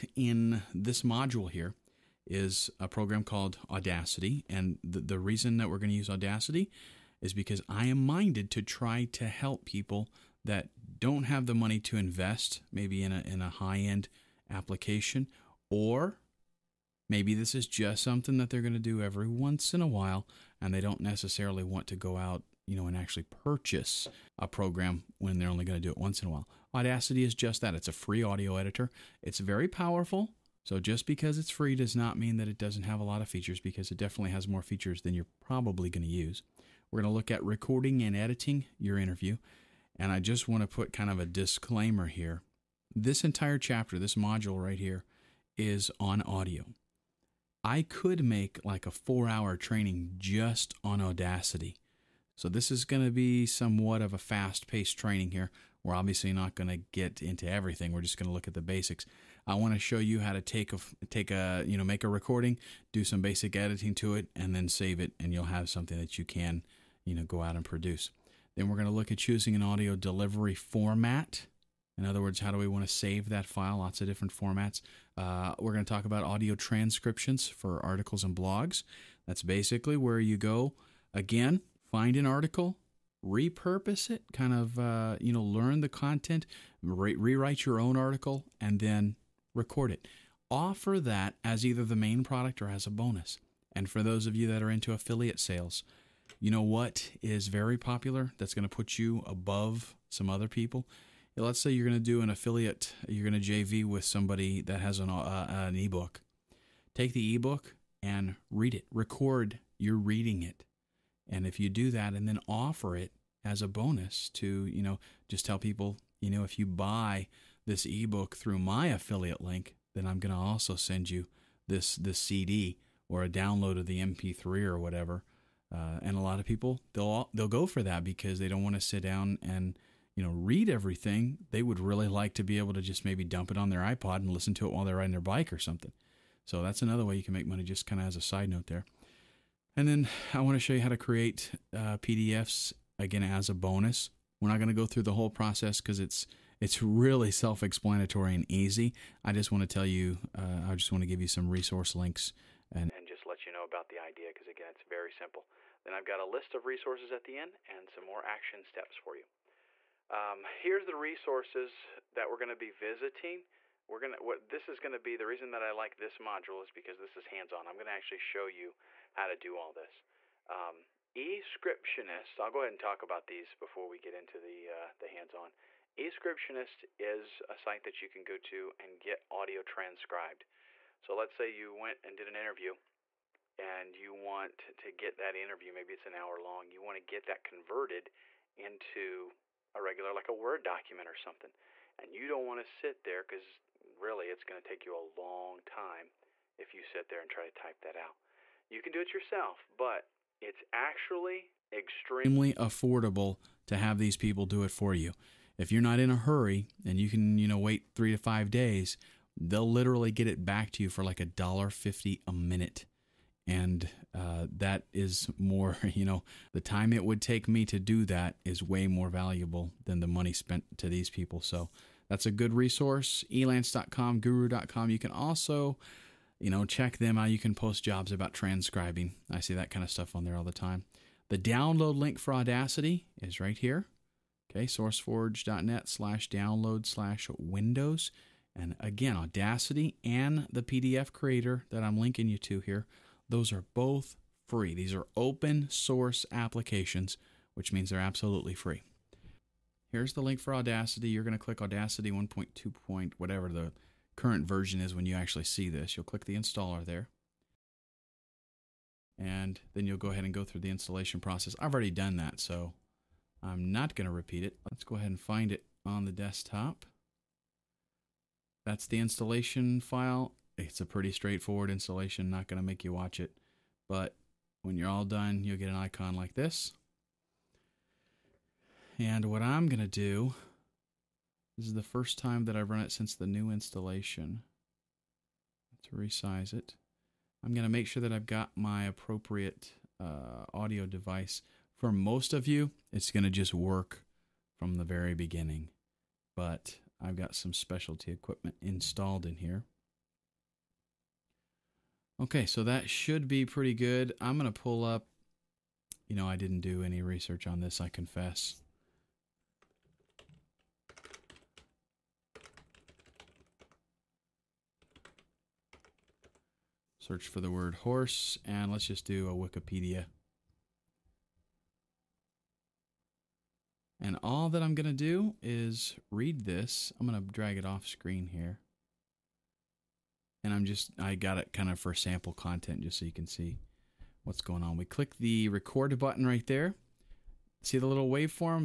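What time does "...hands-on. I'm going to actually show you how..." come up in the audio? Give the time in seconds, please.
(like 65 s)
167 s.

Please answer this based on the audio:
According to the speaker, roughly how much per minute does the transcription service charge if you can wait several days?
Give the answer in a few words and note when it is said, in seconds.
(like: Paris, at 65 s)
$1.50, at 211 s.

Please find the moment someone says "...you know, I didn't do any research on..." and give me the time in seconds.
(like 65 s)
306 s.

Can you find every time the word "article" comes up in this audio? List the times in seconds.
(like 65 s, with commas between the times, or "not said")
77 s, 82 s, 87 s.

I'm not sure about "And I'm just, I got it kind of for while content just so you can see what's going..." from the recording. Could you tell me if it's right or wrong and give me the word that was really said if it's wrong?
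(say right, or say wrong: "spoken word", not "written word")
wrong: "sample", not "while".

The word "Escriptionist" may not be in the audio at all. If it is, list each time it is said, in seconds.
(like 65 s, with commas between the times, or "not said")
171 s, 175 s.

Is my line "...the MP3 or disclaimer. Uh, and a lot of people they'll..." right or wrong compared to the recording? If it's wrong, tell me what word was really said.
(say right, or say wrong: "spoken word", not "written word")
wrong: "whatever", not "disclaimer".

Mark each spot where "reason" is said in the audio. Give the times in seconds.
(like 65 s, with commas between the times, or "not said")
5 s, 165 s.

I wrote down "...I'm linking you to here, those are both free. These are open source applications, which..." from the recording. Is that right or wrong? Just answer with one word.
right.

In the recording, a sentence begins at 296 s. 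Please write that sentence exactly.
But I've got some specialty equipment installed in here.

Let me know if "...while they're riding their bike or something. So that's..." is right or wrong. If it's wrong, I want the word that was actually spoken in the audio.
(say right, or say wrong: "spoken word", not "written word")
right.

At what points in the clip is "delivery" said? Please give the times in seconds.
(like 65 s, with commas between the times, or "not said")
69 s.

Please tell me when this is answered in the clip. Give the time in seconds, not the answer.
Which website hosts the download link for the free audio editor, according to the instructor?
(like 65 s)
234 s.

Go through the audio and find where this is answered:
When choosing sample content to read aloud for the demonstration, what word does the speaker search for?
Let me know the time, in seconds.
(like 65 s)
317 s.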